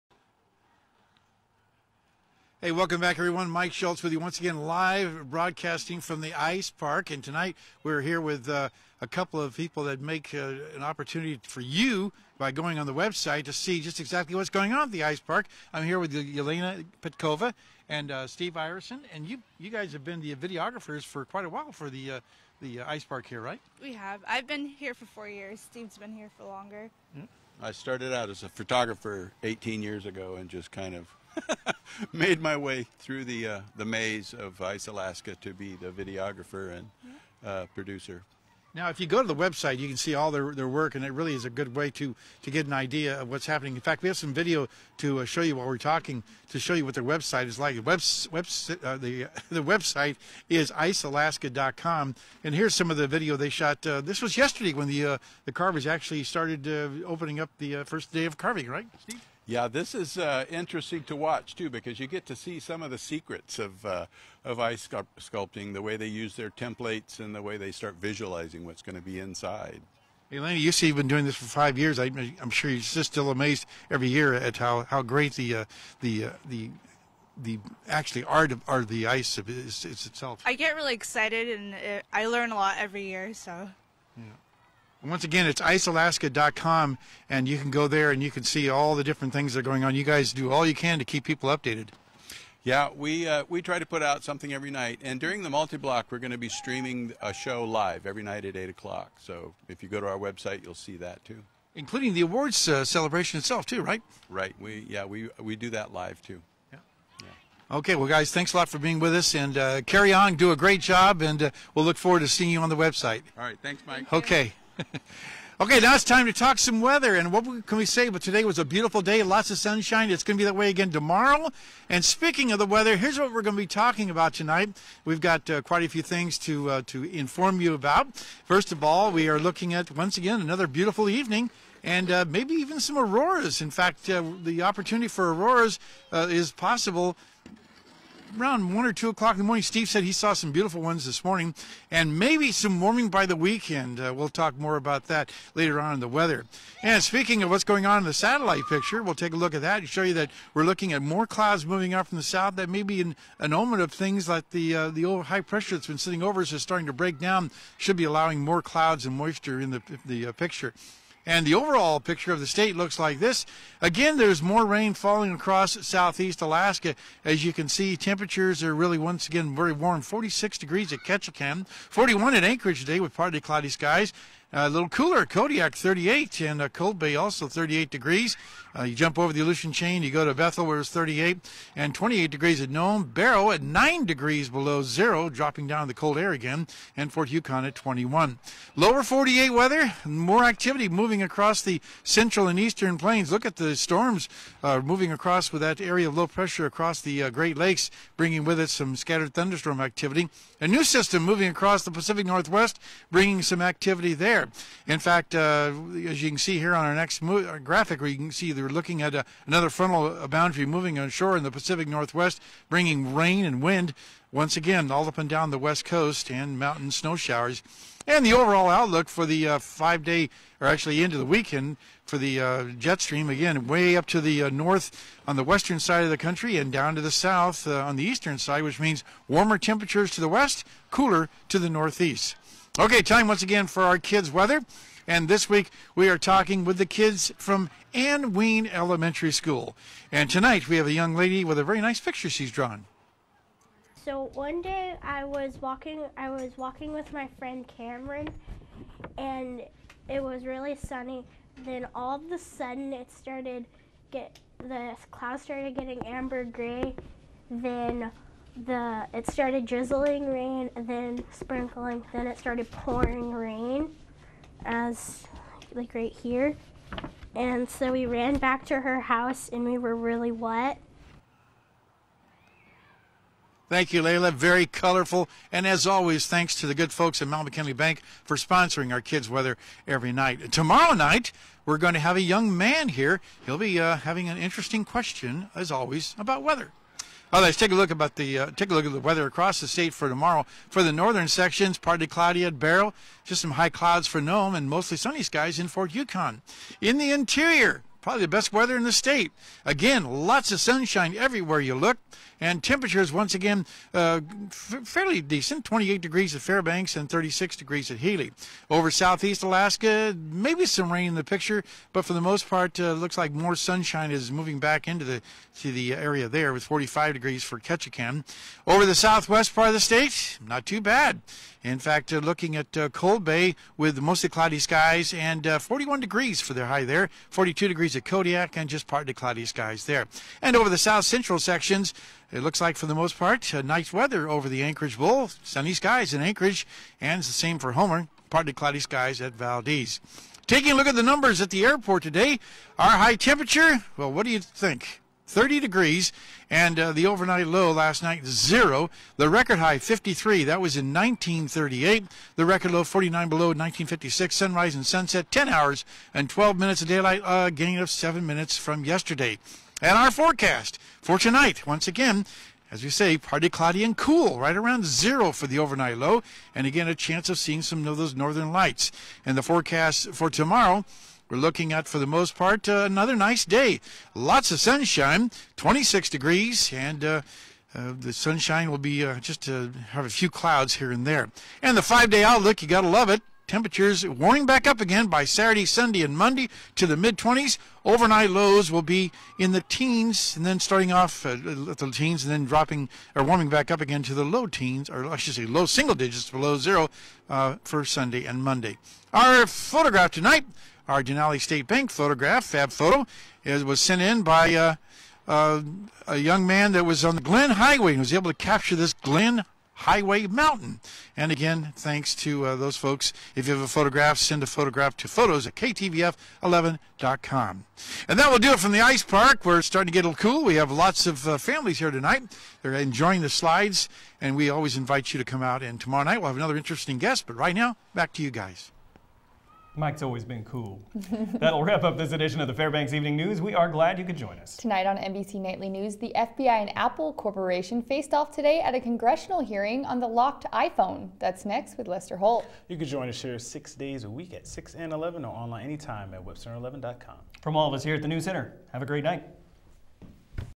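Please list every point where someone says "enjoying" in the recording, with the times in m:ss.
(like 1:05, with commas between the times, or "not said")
7:02.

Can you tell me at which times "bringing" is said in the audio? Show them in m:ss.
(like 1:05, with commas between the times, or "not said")
3:18, 3:23, 3:32.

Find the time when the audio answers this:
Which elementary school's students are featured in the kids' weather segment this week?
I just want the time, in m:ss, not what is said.
3:57.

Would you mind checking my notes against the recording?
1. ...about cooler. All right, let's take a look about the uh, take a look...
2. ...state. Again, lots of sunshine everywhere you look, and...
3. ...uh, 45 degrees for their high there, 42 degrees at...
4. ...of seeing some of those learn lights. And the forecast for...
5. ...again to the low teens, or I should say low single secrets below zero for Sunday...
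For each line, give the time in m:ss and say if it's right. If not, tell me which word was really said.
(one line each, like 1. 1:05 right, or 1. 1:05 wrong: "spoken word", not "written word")
1. 4:46 wrong: "weather", not "cooler"
2. 4:58 right
3. 5:25 wrong: "41", not "45"
4. 6:07 wrong: "northern", not "learn"
5. 6:33 wrong: "digits", not "secrets".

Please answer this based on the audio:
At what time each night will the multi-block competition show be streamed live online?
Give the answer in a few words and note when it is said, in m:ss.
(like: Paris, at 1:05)
8 o'clock, at 1:38.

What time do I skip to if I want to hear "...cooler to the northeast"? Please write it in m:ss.
3:50.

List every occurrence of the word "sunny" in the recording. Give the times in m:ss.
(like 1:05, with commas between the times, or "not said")
4:10, 4:54, 5:35.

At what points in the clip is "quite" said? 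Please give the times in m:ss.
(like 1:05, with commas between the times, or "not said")
0:21, 2:05.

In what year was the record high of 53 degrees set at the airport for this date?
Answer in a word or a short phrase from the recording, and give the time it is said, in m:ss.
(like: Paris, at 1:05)
1938, at 5:50.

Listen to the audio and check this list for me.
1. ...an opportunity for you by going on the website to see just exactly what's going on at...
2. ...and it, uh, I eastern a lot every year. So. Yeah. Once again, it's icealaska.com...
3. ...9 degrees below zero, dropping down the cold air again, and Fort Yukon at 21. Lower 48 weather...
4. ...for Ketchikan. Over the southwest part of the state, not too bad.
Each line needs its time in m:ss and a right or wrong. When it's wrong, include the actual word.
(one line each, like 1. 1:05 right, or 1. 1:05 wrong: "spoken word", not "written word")
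1. 0:10 right
2. 1:21 wrong: "learn", not "eastern"
3. 3:03 right
4. 5:17 right.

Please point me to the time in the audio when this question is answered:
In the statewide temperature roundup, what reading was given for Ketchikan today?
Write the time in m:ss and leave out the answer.
2:50.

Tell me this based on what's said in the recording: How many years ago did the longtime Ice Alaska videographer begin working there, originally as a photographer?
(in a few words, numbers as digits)
18.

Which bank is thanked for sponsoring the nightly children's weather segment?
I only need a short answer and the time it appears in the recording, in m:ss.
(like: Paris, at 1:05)
Mount McKinley Bank, at 4:37.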